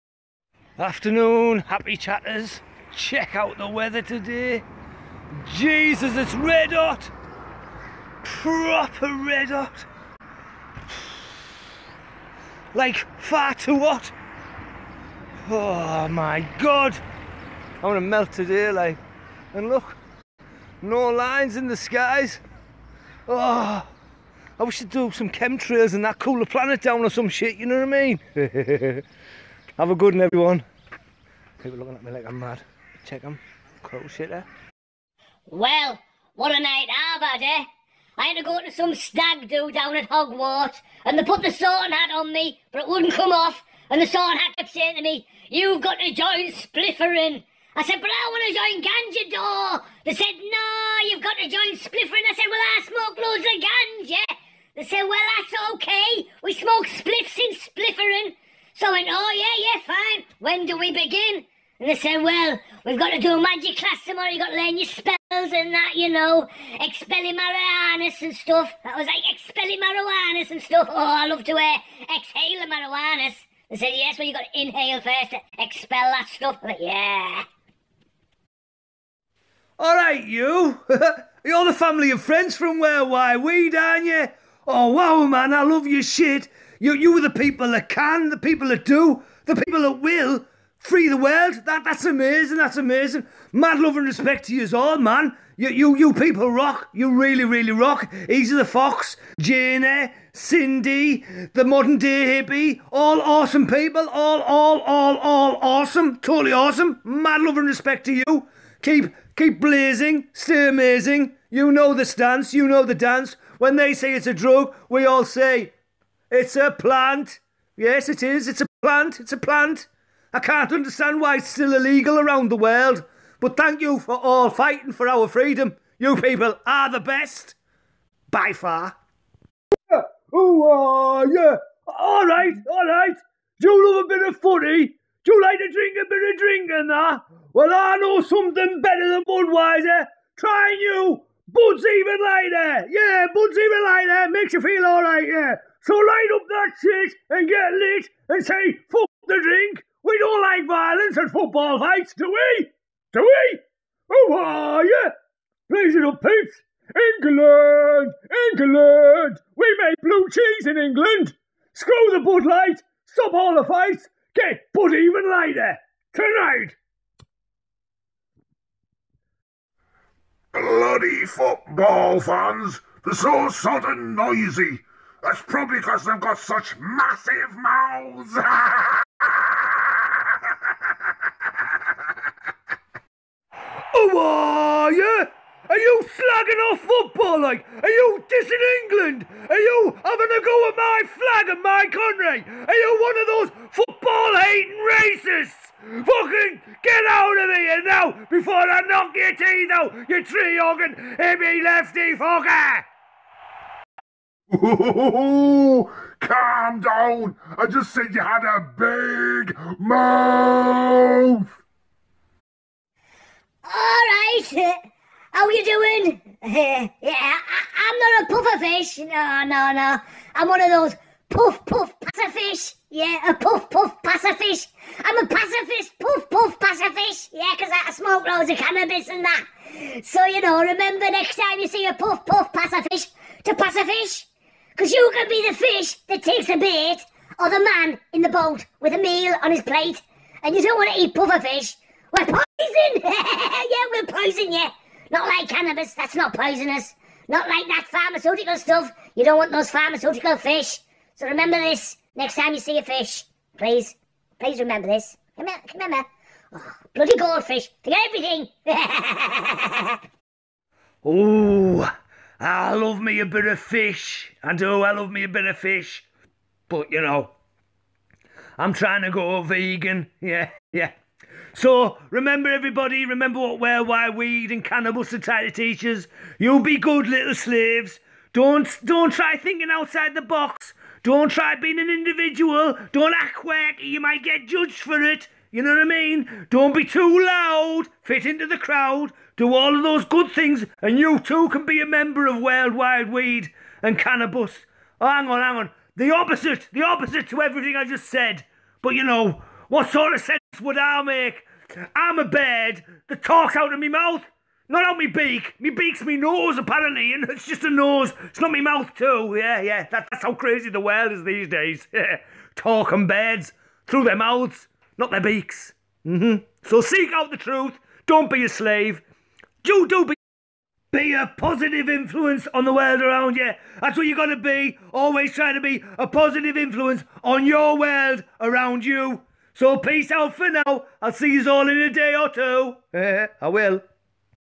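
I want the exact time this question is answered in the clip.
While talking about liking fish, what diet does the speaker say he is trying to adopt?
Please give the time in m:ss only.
4:28.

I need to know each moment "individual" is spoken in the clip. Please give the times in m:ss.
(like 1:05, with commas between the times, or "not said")
4:41.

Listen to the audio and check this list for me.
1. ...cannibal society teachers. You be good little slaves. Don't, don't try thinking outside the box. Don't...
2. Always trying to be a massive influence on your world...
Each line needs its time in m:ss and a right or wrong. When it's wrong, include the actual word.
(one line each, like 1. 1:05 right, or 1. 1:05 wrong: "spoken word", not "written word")
1. 4:34 right
2. 5:24 wrong: "positive", not "massive".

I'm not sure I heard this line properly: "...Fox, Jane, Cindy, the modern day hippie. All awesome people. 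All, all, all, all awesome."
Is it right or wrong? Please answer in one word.
right.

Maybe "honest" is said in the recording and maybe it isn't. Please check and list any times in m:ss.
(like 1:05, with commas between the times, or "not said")
not said.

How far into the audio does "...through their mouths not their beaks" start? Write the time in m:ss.
5:13.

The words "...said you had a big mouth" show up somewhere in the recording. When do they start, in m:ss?
3:27.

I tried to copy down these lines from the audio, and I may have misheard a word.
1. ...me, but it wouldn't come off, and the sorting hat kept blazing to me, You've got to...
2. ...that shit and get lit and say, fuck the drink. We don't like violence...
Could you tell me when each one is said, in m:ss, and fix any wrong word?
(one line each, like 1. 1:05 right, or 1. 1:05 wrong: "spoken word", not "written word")
1. 0:42 wrong: "saying", not "blazing"
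2. 2:26 right.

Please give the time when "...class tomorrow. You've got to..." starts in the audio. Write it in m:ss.
1:03.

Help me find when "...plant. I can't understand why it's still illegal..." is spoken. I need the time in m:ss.
1:59.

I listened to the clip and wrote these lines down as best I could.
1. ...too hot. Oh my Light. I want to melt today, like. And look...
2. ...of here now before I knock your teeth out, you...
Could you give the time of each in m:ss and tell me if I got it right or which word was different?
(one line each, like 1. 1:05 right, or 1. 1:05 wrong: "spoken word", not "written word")
1. 0:13 wrong: "God", not "Light"
2. 3:17 right.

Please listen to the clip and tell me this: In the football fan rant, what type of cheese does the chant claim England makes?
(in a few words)
blue cheese.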